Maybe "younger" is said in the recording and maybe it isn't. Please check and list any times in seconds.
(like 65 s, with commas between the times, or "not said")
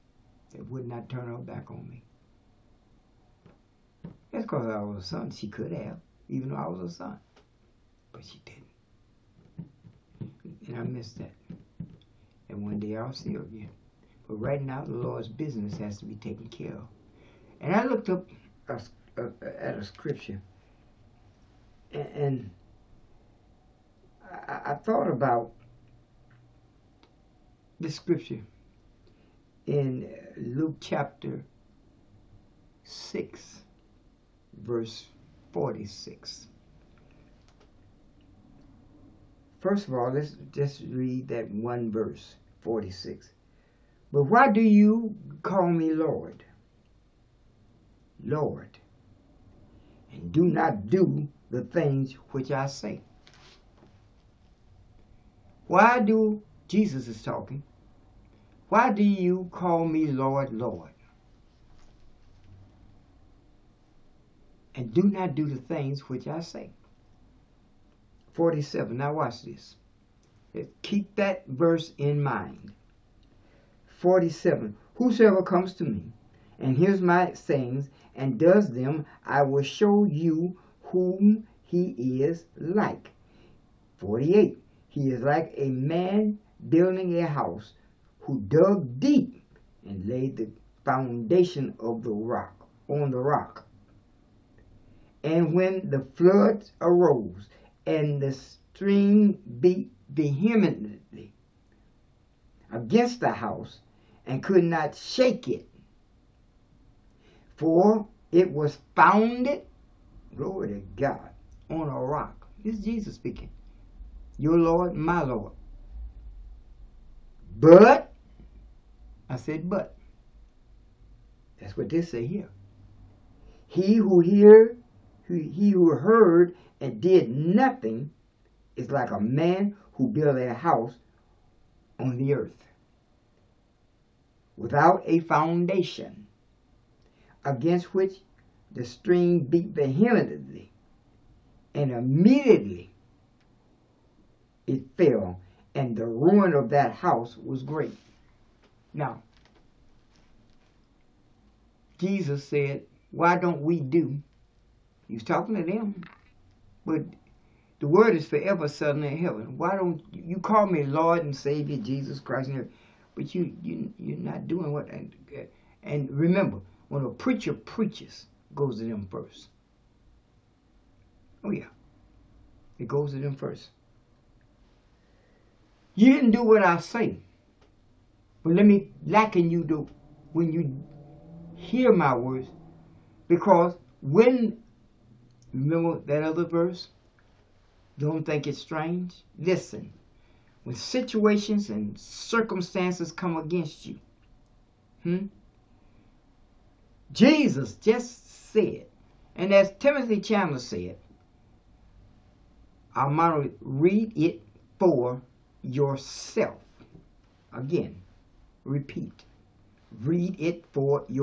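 not said.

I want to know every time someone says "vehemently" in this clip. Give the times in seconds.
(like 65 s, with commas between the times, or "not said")
100 s, 139 s.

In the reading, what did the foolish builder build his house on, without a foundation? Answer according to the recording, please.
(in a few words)
the earth.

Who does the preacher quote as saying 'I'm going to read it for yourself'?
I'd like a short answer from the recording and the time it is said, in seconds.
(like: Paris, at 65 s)
Timothy Chandler, at 199 s.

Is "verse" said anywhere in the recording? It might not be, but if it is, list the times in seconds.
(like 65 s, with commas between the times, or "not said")
34 s, 41 s, 71 s, 186 s.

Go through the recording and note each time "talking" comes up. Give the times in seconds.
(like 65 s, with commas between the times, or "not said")
57 s, 155 s.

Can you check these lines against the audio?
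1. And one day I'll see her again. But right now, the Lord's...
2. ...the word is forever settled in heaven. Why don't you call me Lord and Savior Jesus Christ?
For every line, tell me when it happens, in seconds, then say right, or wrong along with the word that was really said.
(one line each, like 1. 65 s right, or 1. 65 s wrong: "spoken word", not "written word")
1. 12 s right
2. 157 s right.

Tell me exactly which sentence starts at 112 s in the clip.
This is Jesus speaking your Lord, my Lord.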